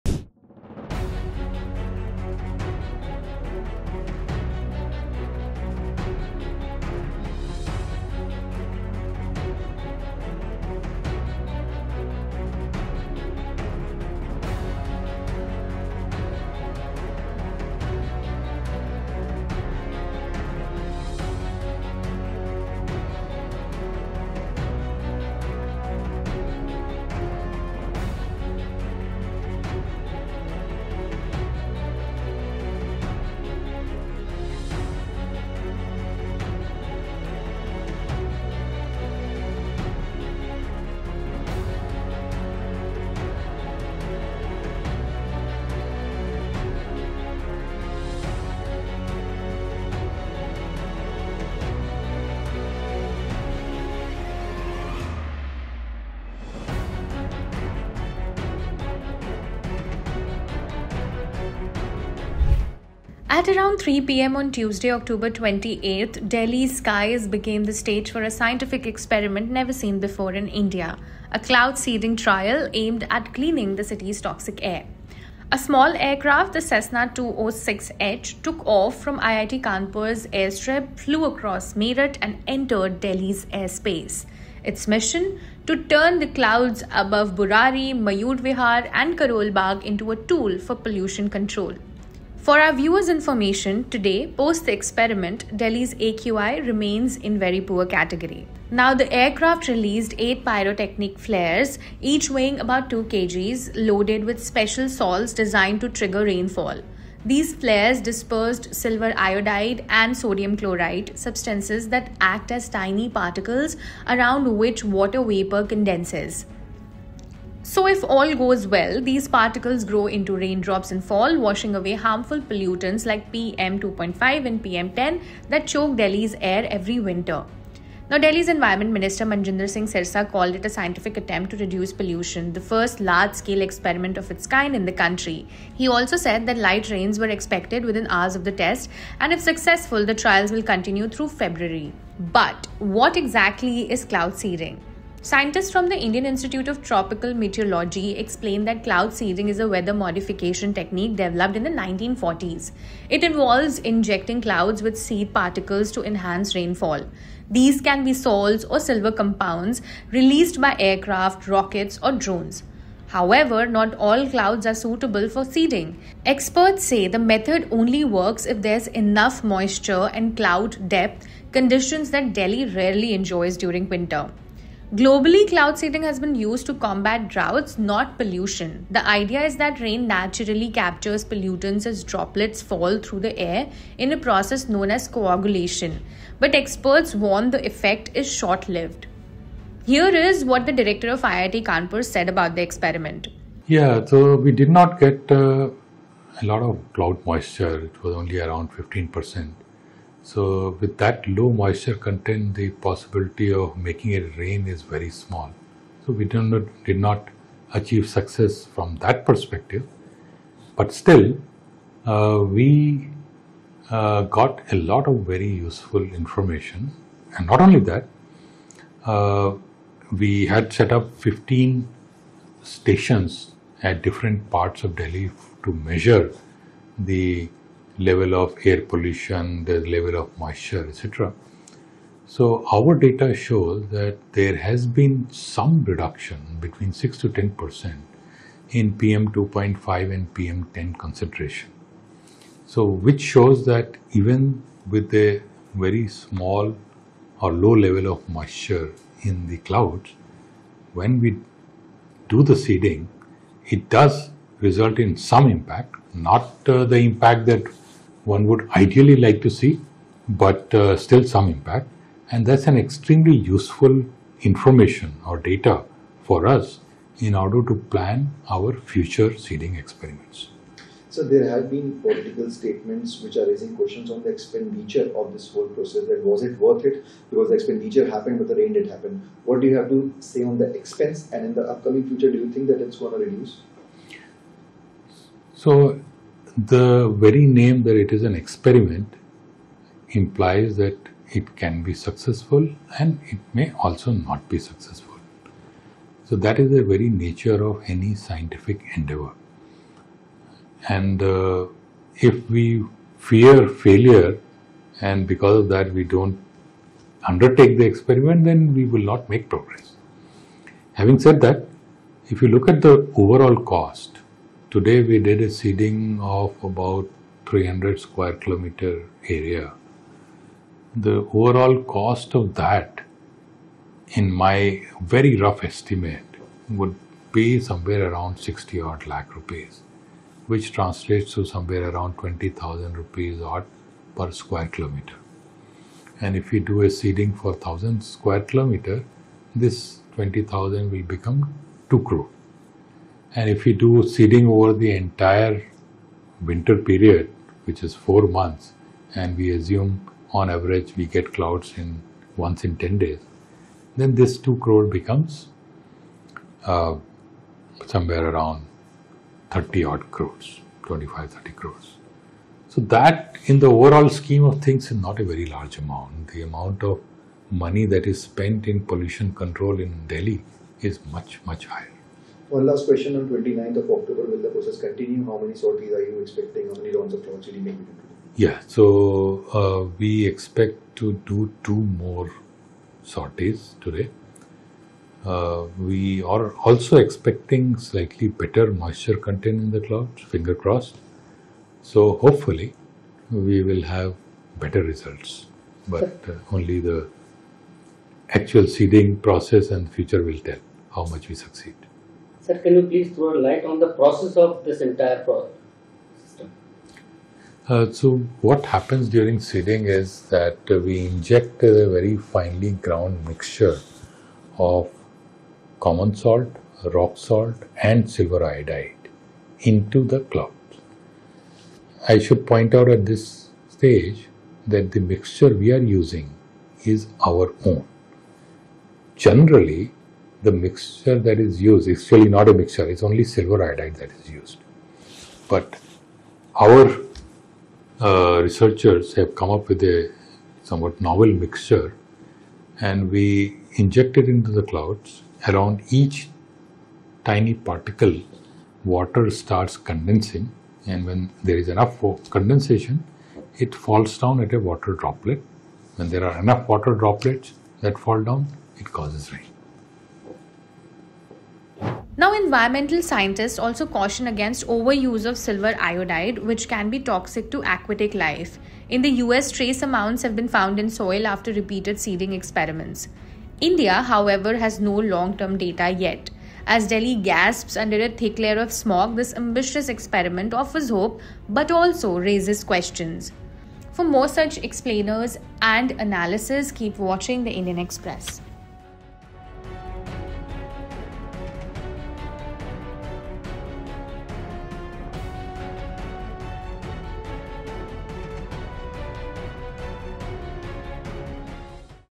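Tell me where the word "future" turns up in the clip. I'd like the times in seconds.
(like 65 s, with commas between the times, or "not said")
268 s, 282 s, 399 s.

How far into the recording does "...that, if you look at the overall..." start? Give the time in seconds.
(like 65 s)
311 s.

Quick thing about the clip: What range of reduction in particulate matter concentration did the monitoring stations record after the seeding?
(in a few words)
6 to 10 percent.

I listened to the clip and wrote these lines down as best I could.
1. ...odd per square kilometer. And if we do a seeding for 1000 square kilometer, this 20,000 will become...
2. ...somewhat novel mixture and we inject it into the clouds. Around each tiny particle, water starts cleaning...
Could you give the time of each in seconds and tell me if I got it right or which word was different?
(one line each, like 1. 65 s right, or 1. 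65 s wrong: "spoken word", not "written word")
1. 333 s right
2. 440 s wrong: "condensing", not "cleaning".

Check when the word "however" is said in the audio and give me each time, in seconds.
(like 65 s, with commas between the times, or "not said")
163 s, 474 s.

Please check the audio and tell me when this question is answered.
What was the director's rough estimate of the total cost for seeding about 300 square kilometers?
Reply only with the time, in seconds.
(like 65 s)
328 s.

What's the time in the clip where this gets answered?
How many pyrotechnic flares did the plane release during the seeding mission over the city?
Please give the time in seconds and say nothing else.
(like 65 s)
100 s.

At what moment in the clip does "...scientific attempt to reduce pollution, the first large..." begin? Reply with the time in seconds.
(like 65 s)
130 s.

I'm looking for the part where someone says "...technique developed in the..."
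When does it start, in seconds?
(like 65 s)
150 s.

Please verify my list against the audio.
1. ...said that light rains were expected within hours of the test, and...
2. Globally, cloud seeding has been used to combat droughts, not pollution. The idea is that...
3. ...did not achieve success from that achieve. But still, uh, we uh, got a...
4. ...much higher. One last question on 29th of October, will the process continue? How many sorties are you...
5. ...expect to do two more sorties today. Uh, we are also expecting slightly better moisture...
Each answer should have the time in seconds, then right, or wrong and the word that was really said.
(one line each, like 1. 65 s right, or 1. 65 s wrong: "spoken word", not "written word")
1. 136 s right
2. 174 s right
3. 206 s wrong: "perspective", not "achieve"
4. 371 s right
5. 380 s right.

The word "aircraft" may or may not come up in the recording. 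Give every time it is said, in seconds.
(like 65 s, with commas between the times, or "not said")
76 s, 99 s, 160 s.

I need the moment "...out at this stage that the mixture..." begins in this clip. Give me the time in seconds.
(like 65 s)
422 s.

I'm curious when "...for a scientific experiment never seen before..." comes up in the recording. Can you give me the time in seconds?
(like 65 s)
68 s.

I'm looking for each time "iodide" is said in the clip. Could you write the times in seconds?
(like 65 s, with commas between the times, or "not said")
109 s, 418 s, 433 s, 465 s.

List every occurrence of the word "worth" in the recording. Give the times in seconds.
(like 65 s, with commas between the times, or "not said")
276 s.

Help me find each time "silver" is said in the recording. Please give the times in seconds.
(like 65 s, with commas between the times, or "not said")
108 s, 158 s, 418 s, 433 s, 465 s.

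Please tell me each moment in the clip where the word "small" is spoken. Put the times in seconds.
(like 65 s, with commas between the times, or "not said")
75 s, 205 s, 246 s.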